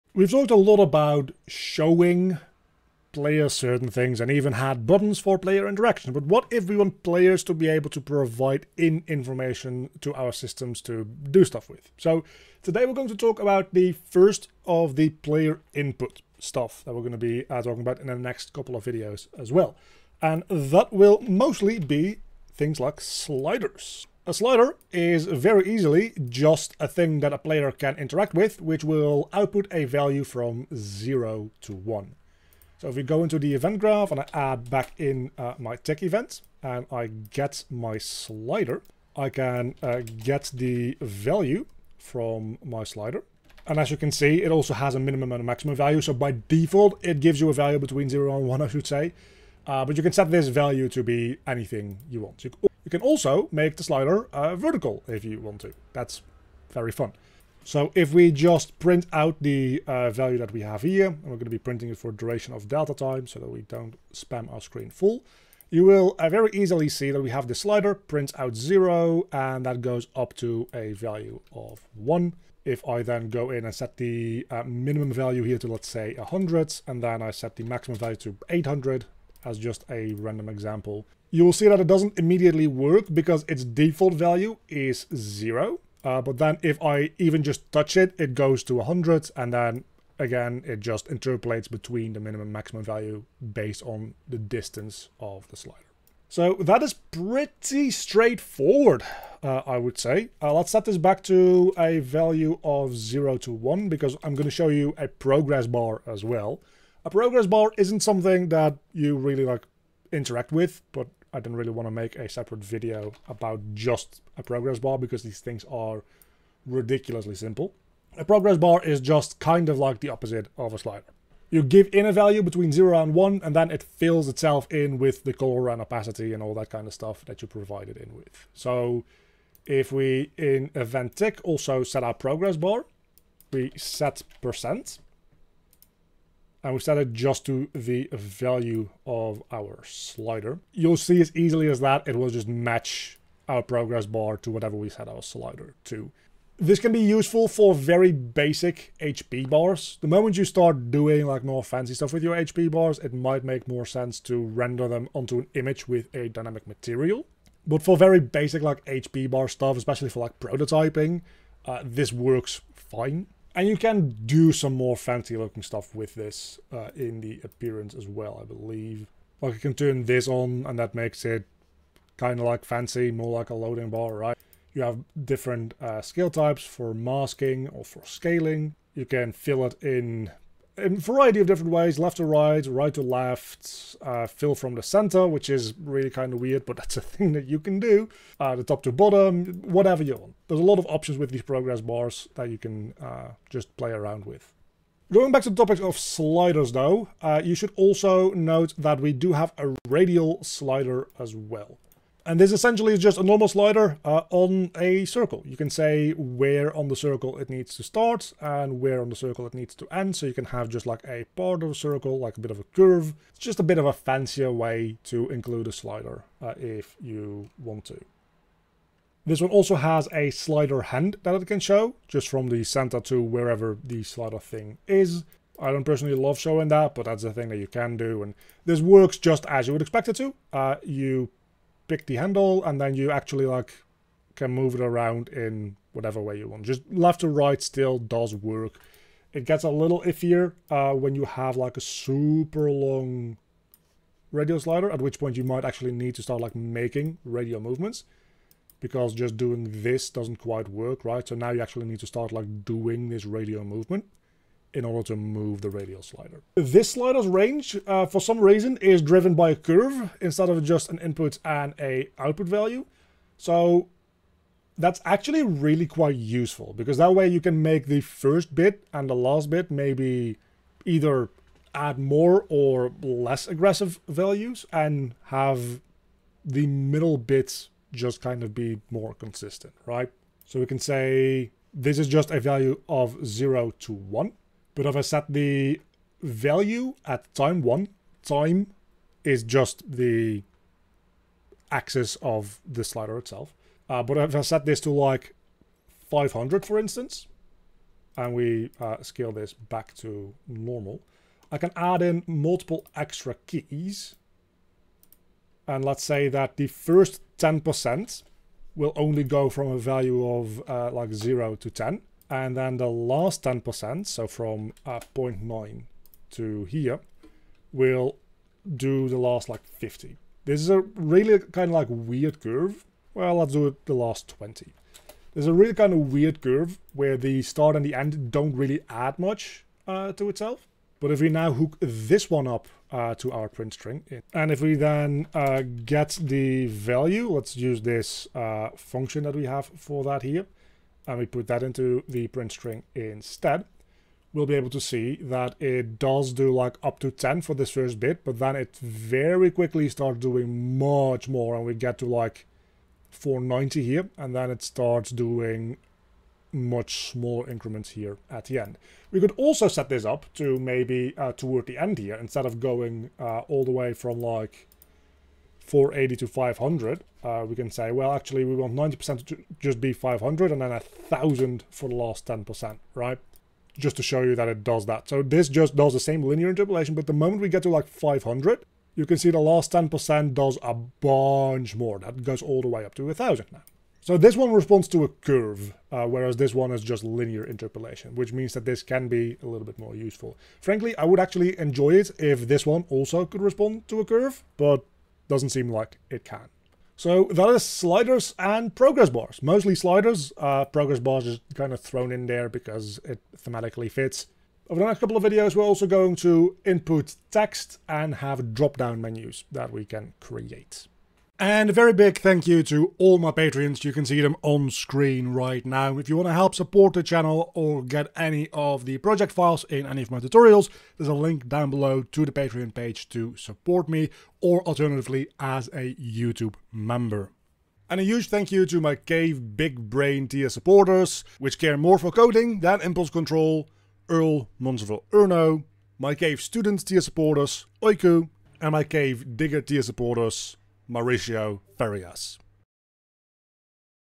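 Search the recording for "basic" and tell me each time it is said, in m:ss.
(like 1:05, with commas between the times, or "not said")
2:28, 2:38.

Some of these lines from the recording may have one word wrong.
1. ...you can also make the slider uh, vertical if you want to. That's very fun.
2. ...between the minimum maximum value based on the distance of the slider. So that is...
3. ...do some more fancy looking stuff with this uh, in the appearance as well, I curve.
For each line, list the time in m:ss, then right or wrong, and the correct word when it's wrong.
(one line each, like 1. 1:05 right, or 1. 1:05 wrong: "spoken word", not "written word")
1. 0:52 right
2. 1:31 right
3. 2:44 wrong: "believe", not "curve".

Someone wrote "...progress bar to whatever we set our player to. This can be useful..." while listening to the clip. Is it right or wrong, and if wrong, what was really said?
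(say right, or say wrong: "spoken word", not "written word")
wrong: "slider", not "player".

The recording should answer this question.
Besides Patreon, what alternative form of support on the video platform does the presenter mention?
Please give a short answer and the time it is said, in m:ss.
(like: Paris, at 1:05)
YouTube member, at 7:05.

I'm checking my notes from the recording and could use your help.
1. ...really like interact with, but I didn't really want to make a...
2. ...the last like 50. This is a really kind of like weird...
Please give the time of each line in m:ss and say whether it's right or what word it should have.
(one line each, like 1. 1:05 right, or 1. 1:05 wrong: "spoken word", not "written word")
1. 1:49 right
2. 5:19 right.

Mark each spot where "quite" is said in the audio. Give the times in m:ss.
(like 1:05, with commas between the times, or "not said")
4:10, 4:25.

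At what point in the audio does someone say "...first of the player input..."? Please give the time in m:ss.
0:13.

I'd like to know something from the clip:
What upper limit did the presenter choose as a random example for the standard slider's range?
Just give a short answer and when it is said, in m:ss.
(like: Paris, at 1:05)
800, at 1:18.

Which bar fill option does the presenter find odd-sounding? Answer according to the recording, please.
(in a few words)
fill from the center.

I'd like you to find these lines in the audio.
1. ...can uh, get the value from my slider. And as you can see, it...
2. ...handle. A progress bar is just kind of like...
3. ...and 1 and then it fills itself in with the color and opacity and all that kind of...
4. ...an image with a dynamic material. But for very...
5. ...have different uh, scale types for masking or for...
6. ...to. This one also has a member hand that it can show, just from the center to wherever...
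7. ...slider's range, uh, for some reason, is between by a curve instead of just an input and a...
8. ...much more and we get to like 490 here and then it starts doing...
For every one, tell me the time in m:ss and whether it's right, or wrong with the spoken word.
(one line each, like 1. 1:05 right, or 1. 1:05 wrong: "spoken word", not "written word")
1. 0:39 right
2. 1:57 wrong: "simple", not "handle"
3. 2:03 right
4. 2:35 right
5. 2:54 right
6. 3:37 wrong: "slider", not "member"
7. 4:16 wrong: "driven", not "between"
8. 5:50 right.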